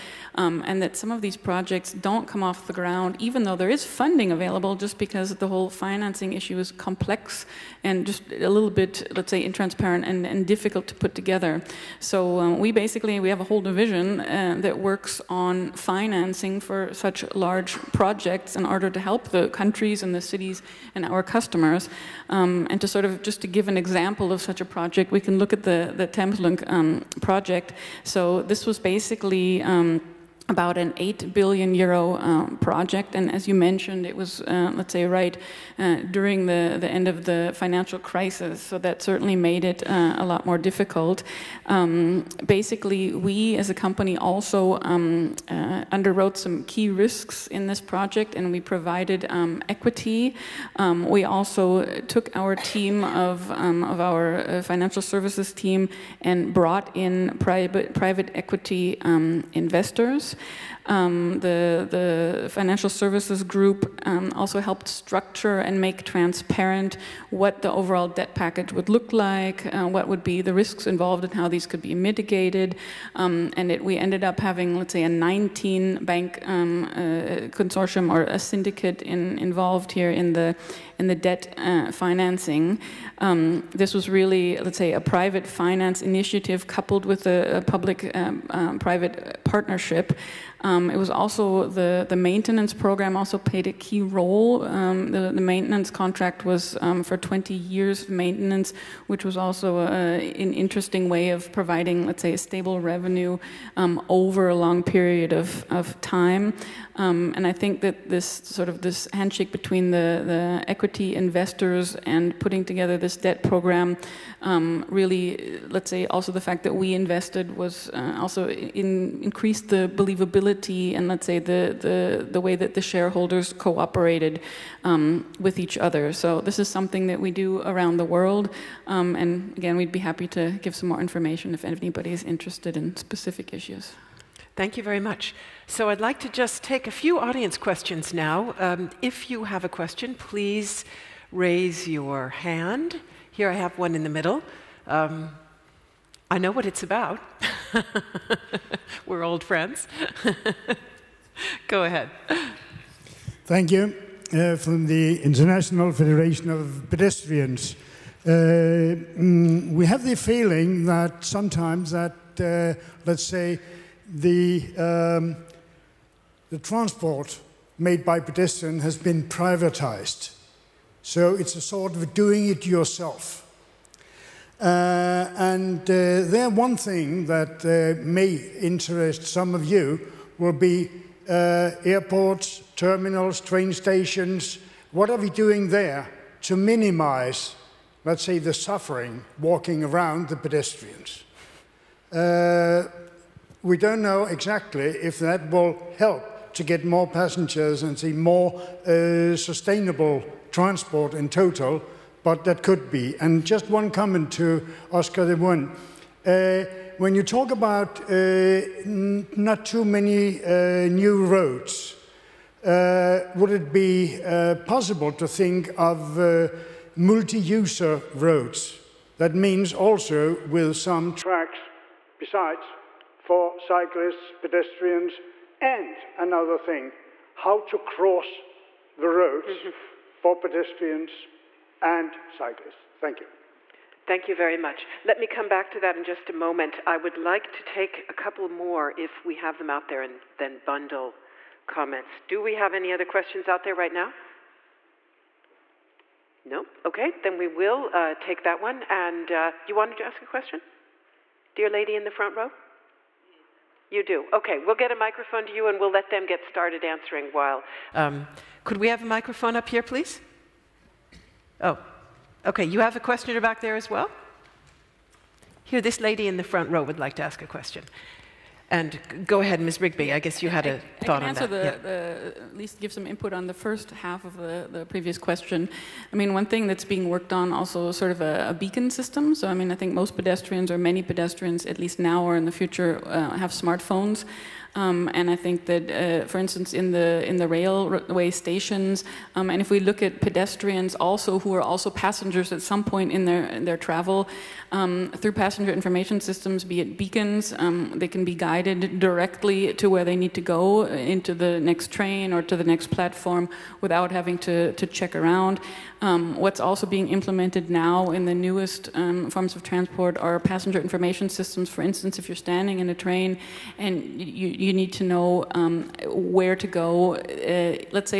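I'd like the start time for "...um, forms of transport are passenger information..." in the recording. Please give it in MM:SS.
05:08.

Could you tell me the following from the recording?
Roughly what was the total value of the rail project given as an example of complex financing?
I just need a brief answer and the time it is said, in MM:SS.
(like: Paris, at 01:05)
8 billion euro, at 00:30.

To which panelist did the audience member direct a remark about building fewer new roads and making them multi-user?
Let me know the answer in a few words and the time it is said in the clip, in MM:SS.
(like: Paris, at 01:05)
Oscar de Buen, at 03:24.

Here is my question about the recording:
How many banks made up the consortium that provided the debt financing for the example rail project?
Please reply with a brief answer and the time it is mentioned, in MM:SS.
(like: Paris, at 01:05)
19, at 01:15.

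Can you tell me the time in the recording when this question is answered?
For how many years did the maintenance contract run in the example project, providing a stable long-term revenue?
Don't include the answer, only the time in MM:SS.
01:37.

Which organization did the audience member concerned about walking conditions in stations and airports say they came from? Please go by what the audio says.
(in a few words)
International Federation of Pedestrians.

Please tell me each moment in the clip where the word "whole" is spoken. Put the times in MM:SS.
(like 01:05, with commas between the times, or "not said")
00:05, 00:13.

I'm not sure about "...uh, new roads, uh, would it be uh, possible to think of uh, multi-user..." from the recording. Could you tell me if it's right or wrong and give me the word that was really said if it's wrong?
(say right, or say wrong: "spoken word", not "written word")
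right.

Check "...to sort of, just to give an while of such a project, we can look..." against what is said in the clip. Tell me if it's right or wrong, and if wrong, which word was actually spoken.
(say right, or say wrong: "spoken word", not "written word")
wrong: "example", not "while".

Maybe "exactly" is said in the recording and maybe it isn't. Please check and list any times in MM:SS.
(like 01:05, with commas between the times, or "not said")
03:14.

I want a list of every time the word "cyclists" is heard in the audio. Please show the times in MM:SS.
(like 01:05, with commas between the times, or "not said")
03:43, 03:52.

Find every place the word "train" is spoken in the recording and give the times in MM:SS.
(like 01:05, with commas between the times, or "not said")
03:03, 05:01, 05:12.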